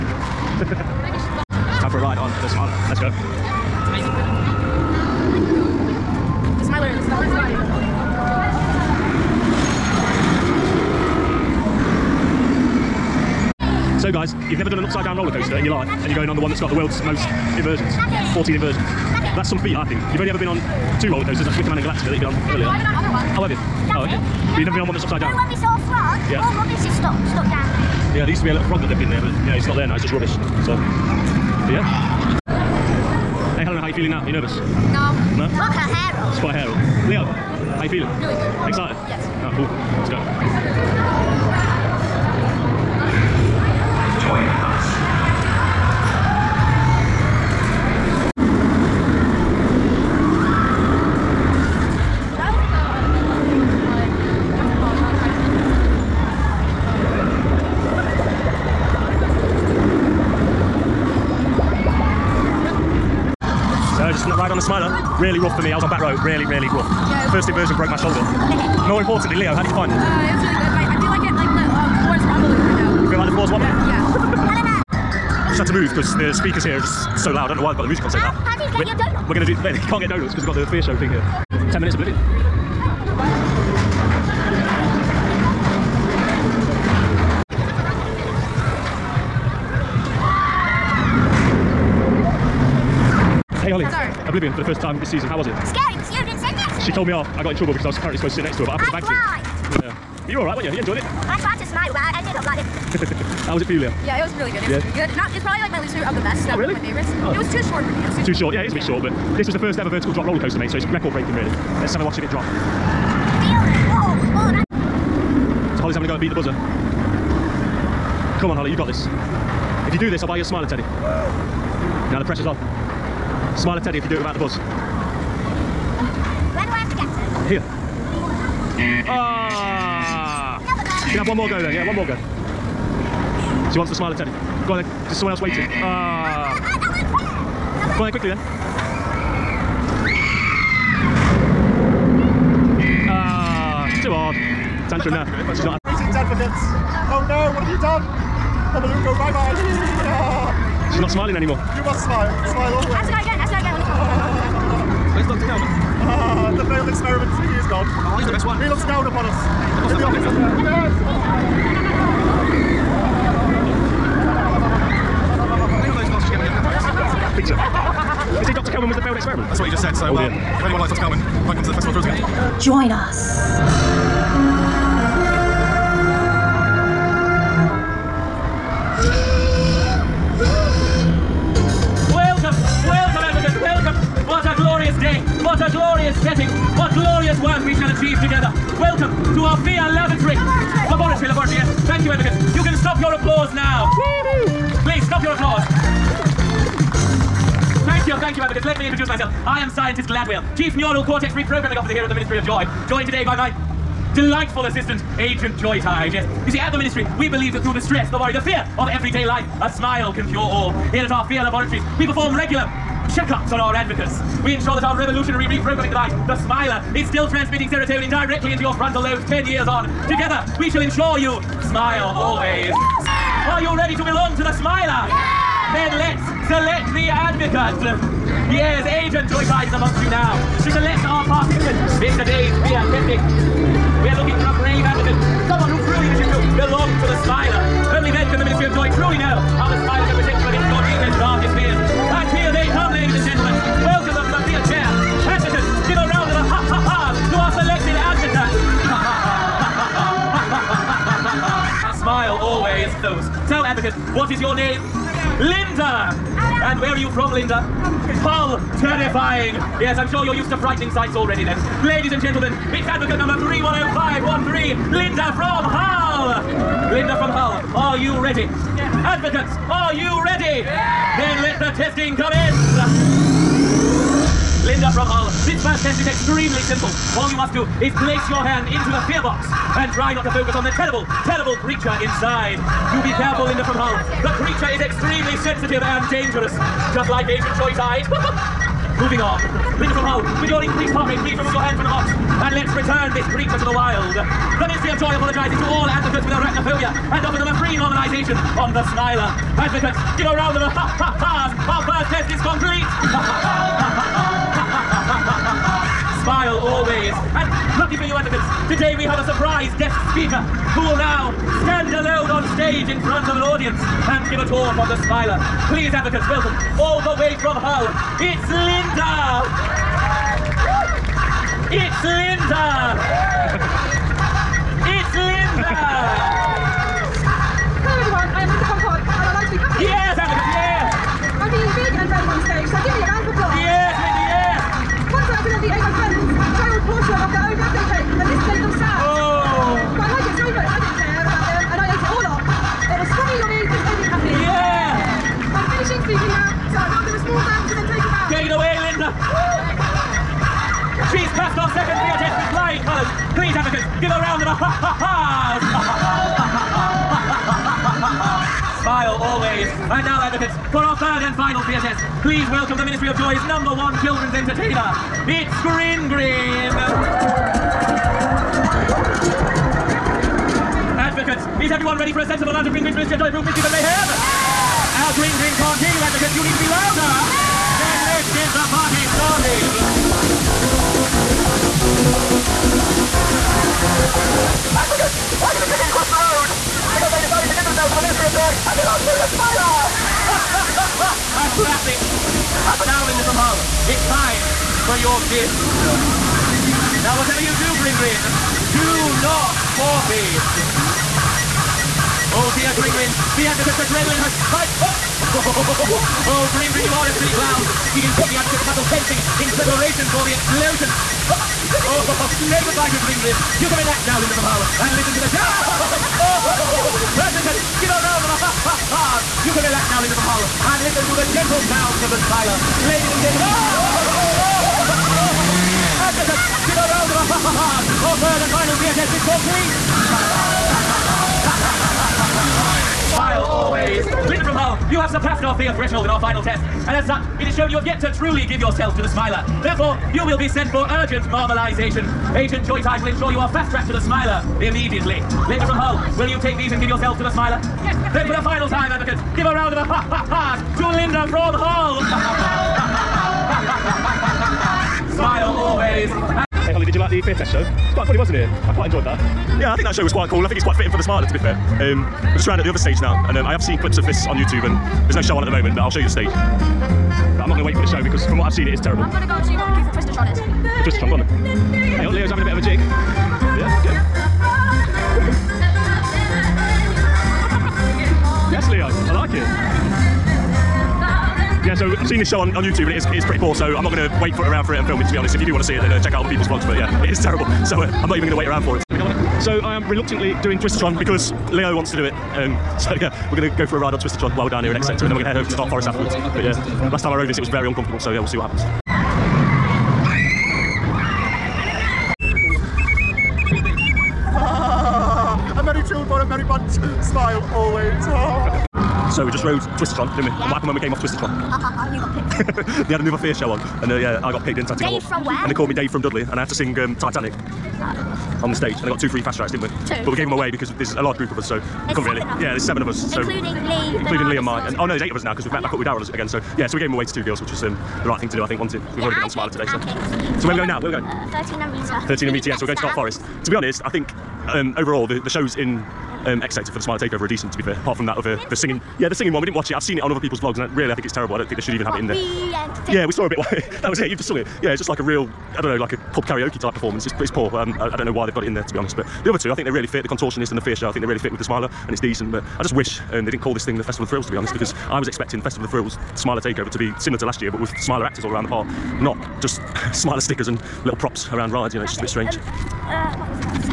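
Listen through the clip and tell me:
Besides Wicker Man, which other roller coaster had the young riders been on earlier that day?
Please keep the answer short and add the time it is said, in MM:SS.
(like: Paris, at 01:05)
Galactica, at 00:21.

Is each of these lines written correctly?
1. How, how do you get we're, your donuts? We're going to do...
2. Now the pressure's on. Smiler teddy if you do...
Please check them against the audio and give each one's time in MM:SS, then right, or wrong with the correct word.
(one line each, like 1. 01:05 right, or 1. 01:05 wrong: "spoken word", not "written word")
1. 01:18 right
2. 02:02 right.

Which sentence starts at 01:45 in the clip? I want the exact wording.
No, it's probably like my least favorite of the best.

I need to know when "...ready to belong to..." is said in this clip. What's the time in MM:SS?
03:43.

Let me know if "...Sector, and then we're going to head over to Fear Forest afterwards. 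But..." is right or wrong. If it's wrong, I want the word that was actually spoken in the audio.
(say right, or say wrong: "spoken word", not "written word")
wrong: "Dark", not "Fear".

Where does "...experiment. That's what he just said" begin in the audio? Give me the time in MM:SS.
02:49.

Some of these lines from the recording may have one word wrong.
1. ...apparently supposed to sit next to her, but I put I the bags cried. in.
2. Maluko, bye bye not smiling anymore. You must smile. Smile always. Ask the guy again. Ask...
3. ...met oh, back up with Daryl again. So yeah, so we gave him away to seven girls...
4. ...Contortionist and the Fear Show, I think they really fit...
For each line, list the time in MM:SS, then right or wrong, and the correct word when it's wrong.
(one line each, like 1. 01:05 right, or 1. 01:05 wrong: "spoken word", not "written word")
1. 01:37 right
2. 02:28 right
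3. 08:45 wrong: "two", not "seven"
4. 09:10 right.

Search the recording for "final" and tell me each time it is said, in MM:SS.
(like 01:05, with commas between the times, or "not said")
06:01, 07:08, 07:16, 07:28.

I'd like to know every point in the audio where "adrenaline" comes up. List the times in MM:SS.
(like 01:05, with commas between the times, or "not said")
06:43.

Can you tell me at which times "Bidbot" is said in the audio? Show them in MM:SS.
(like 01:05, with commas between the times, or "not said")
not said.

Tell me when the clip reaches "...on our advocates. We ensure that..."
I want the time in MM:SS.
03:33.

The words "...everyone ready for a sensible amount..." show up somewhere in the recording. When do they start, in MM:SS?
06:11.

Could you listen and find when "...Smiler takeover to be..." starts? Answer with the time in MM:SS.
09:16.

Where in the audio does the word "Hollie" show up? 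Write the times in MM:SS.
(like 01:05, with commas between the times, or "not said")
01:33, 01:58, 07:36.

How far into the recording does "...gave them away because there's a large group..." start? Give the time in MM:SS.
08:40.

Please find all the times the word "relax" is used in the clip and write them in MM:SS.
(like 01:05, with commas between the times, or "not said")
06:53, 06:59.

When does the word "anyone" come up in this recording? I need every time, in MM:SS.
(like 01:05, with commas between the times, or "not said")
02:50.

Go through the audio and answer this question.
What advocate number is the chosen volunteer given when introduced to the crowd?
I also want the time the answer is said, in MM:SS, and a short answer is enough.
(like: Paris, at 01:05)
310513, at 04:23.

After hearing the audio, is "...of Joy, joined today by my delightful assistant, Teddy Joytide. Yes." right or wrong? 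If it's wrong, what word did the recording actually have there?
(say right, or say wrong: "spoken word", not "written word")
wrong: "Agent", not "Teddy".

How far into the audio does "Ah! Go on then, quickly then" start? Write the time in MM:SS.
02:15.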